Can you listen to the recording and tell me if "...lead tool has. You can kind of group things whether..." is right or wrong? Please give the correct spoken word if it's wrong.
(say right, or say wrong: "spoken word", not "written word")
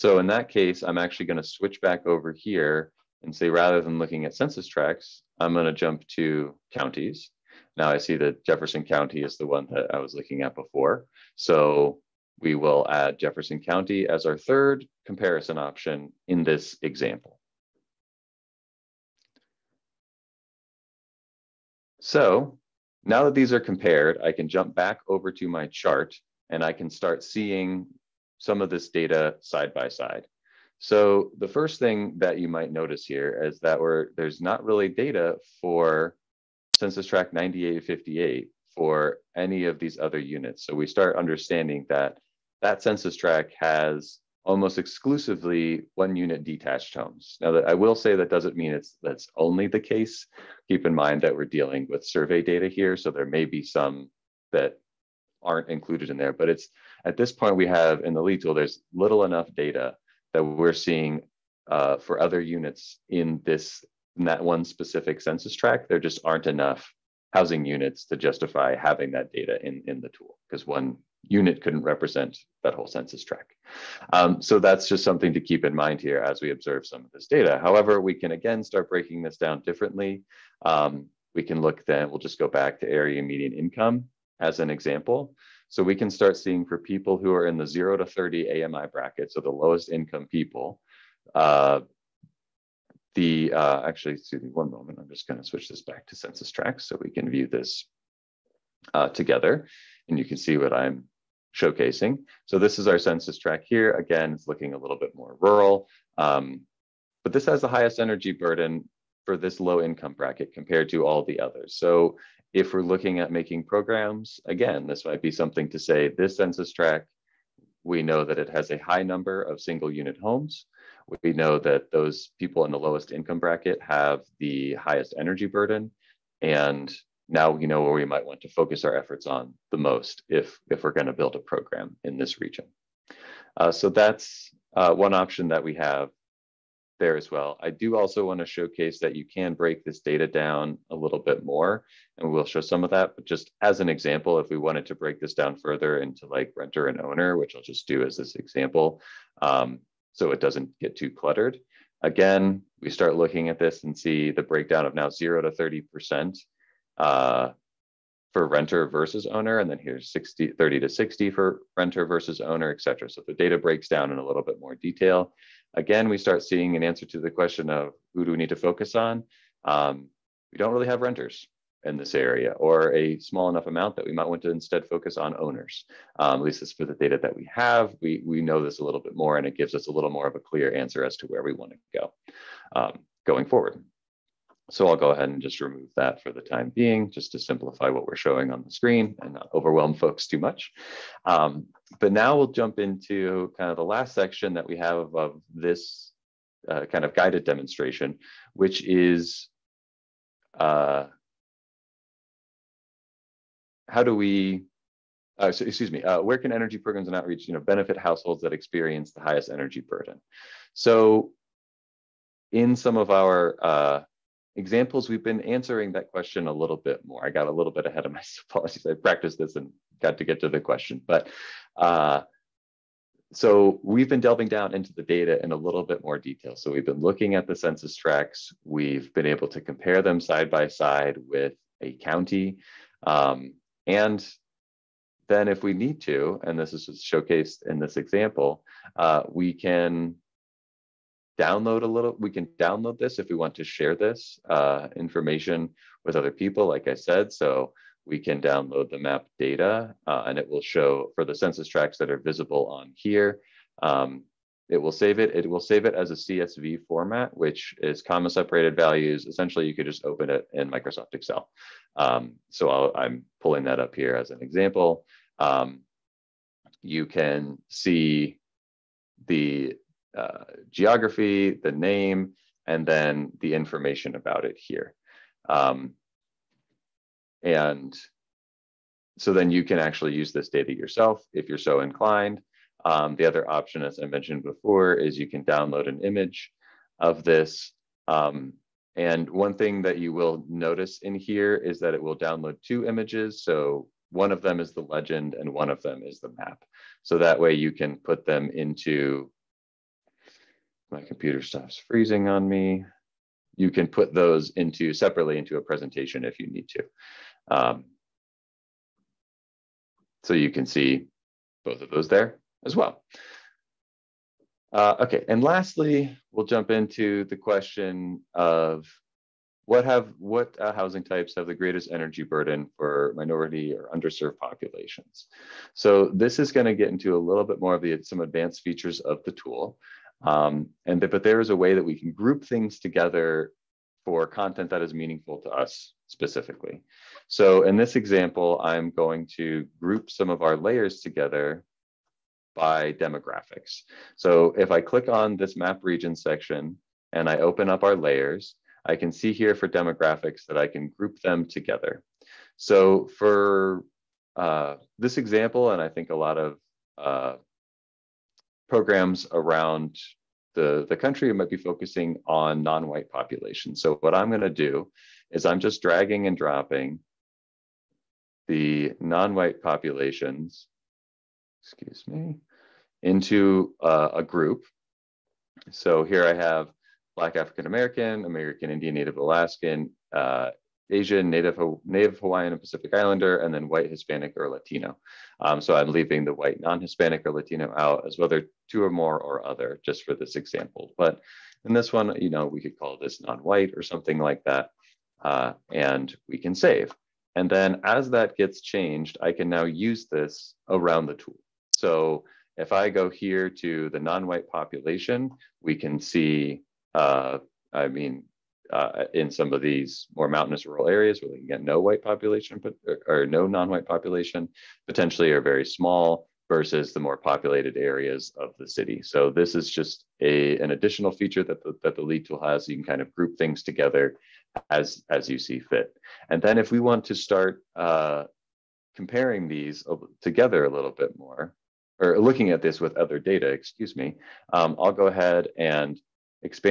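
wrong: "together", not "whether".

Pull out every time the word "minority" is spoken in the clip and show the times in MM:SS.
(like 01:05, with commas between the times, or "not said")
05:23.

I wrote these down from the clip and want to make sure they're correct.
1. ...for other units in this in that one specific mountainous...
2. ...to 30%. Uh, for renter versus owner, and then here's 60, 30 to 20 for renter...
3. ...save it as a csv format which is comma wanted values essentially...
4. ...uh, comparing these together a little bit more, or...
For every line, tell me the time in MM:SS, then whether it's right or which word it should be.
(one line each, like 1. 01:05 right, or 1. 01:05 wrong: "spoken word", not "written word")
1. 01:01 wrong: "census", not "mountainous"
2. 02:35 wrong: "60", not "20"
3. 04:15 wrong: "separated", not "wanted"
4. 07:07 right.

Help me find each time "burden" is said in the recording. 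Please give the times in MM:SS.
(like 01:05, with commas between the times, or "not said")
01:48, 02:05, 03:29, 05:22.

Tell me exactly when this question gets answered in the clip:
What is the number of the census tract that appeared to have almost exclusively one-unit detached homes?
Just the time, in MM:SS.
00:37.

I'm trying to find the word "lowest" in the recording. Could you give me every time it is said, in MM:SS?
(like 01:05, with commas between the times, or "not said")
01:29, 02:02.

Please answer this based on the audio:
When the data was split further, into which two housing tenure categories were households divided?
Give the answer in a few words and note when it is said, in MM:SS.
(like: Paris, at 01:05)
renter and owner, at 02:26.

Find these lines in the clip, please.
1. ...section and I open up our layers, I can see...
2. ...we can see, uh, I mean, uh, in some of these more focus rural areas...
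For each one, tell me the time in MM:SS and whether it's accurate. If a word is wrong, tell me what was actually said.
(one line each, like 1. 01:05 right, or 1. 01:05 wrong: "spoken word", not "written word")
1. 05:46 right
2. 06:45 wrong: "mountainous", not "focus".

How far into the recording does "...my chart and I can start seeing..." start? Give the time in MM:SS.
00:25.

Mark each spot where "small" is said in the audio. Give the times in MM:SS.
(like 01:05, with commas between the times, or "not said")
02:53, 06:55.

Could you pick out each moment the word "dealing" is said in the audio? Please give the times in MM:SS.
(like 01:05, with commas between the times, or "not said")
00:51.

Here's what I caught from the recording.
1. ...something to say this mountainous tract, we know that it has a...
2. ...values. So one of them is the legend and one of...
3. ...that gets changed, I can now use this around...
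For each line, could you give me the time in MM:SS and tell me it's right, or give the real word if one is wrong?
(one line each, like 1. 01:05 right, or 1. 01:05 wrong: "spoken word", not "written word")
1. 01:55 wrong: "census", not "mountainous"
2. 04:52 wrong: "images", not "values"
3. 06:38 right.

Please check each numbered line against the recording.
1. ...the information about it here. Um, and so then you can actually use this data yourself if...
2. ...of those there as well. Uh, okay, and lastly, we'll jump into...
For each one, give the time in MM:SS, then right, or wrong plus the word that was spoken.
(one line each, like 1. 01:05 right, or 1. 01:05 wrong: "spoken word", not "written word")
1. 04:33 right
2. 05:11 right.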